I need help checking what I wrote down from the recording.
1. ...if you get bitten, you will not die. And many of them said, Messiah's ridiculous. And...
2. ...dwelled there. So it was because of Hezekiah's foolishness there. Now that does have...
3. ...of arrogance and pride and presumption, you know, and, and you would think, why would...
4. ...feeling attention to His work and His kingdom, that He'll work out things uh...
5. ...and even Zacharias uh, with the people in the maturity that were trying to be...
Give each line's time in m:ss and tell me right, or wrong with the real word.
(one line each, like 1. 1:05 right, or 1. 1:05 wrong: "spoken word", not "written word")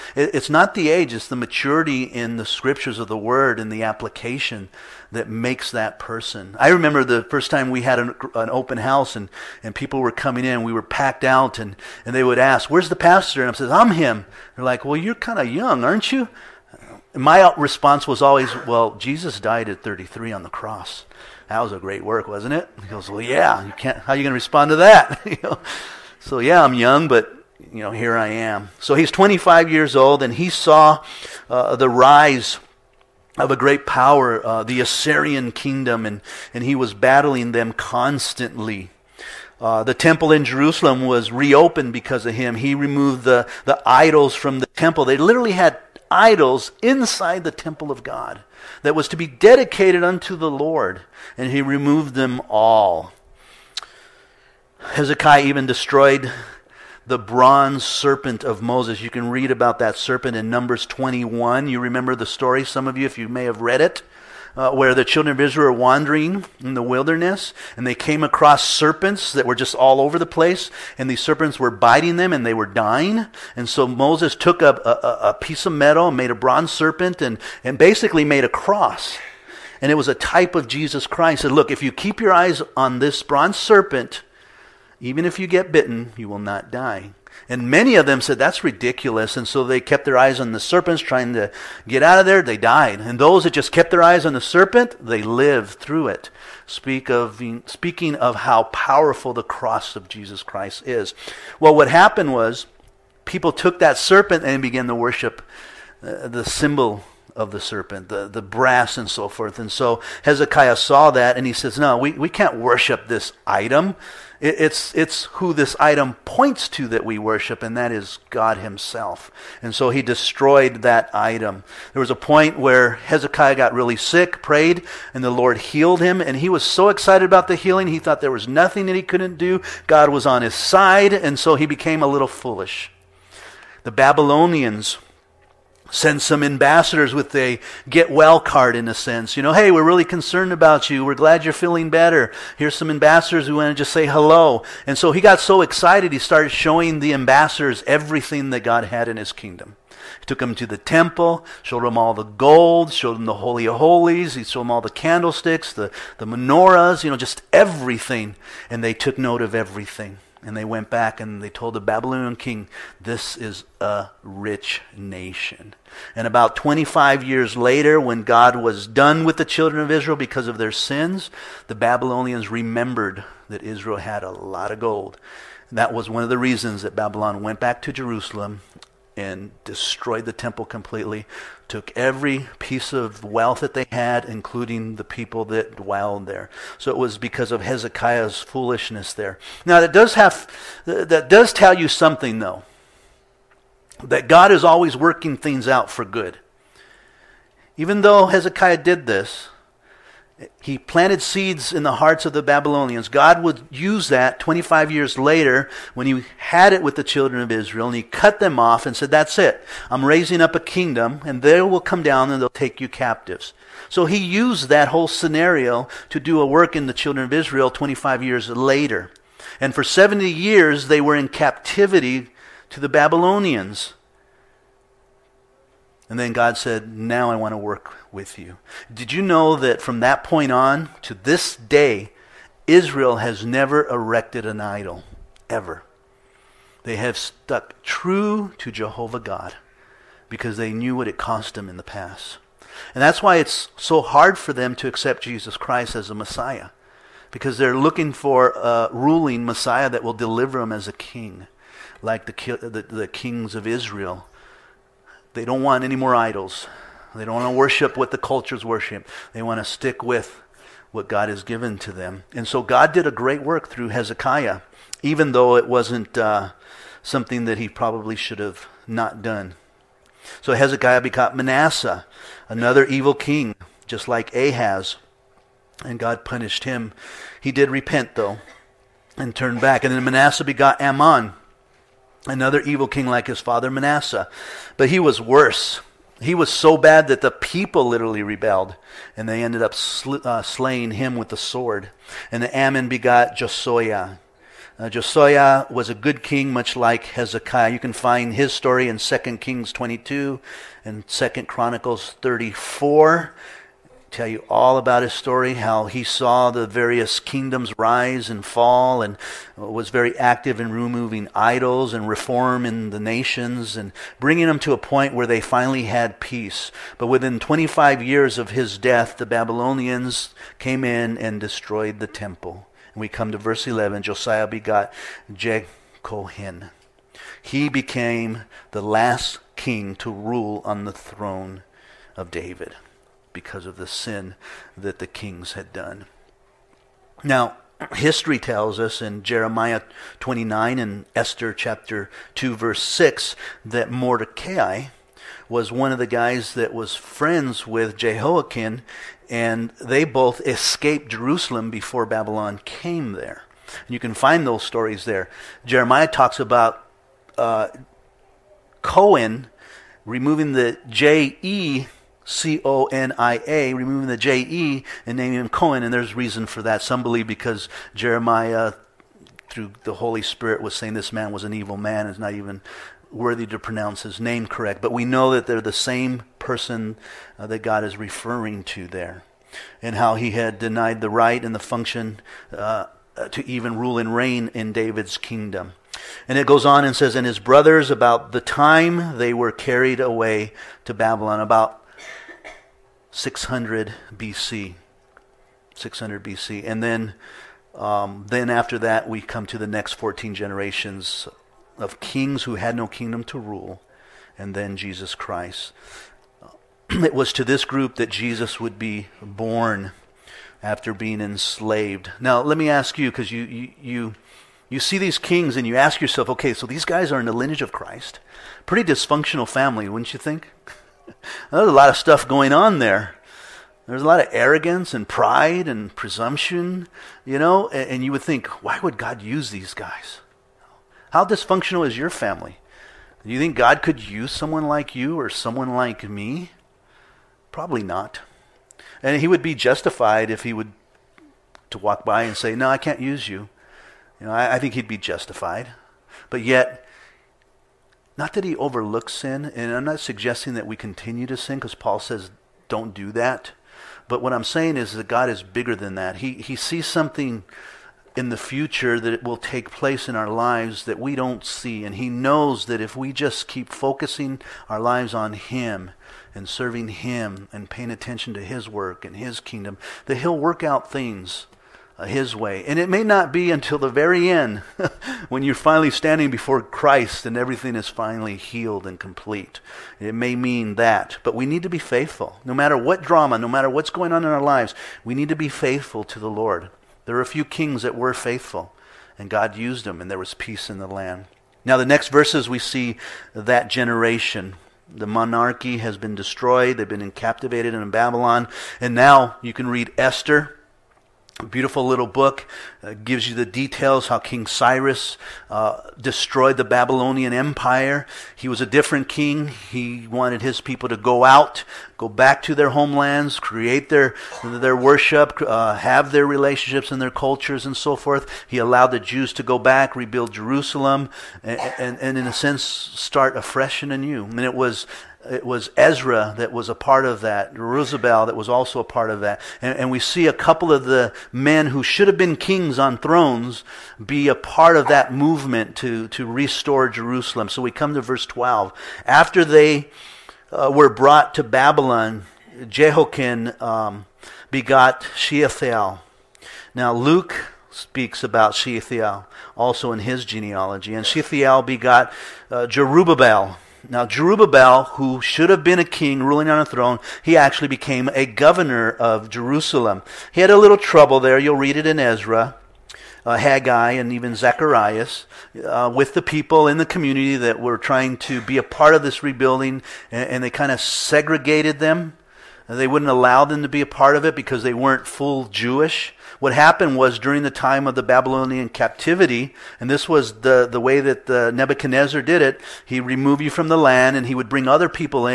1. 1:25 wrong: "That", not "Messiah"
2. 3:05 right
3. 7:04 right
4. 7:47 wrong: "paying", not "feeling"
5. 9:23 wrong: "community", not "maturity".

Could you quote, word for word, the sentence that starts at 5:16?
But within 25 years of his death, the Babylonians came in and destroyed the temple.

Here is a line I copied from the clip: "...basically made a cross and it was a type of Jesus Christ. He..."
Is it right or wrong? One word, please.
right.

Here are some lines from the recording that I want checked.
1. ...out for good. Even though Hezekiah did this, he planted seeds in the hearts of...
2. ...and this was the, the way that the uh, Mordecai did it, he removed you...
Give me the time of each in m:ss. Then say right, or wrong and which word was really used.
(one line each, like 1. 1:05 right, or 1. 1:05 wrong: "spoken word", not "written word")
1. 3:15 right
2. 9:39 wrong: "Nebuchadnezzar", not "Mordecai".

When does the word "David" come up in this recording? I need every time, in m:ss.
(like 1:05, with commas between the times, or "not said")
5:32, 6:24.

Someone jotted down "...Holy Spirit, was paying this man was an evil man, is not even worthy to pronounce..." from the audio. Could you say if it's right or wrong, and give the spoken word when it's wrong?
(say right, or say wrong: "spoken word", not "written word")
wrong: "saying", not "paying".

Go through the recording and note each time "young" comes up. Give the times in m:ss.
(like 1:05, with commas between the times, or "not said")
0:15, 0:26.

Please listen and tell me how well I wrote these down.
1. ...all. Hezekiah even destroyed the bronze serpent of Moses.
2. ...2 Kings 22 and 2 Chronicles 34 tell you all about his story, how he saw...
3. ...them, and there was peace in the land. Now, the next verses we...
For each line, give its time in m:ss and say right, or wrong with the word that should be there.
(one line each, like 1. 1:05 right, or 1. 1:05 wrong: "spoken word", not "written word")
1. 0:52 right
2. 4:58 right
3. 8:09 right.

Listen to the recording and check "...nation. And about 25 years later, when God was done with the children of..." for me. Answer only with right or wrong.
right.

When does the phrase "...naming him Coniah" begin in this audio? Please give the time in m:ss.
6:05.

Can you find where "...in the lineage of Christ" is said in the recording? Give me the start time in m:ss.
6:57.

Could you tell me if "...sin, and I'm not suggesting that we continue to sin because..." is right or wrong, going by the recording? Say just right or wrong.
right.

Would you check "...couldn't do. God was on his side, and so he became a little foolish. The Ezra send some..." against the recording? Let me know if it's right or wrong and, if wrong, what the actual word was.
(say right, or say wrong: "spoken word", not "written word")
wrong: "Babylonians", not "Ezra".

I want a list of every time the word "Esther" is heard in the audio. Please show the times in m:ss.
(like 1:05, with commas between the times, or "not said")
5:41, 8:19.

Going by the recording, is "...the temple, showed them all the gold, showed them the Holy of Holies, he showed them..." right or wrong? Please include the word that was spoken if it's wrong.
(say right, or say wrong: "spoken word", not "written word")
right.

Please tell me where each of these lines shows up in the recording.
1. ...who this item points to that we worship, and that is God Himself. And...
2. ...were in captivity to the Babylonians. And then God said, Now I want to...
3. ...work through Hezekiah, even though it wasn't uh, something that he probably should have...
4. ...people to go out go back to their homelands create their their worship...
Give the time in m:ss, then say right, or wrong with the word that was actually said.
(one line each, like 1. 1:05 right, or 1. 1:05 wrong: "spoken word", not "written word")
1. 1:55 right
2. 3:41 right
3. 4:23 right
4. 8:30 right.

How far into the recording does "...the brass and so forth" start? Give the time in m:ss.
1:48.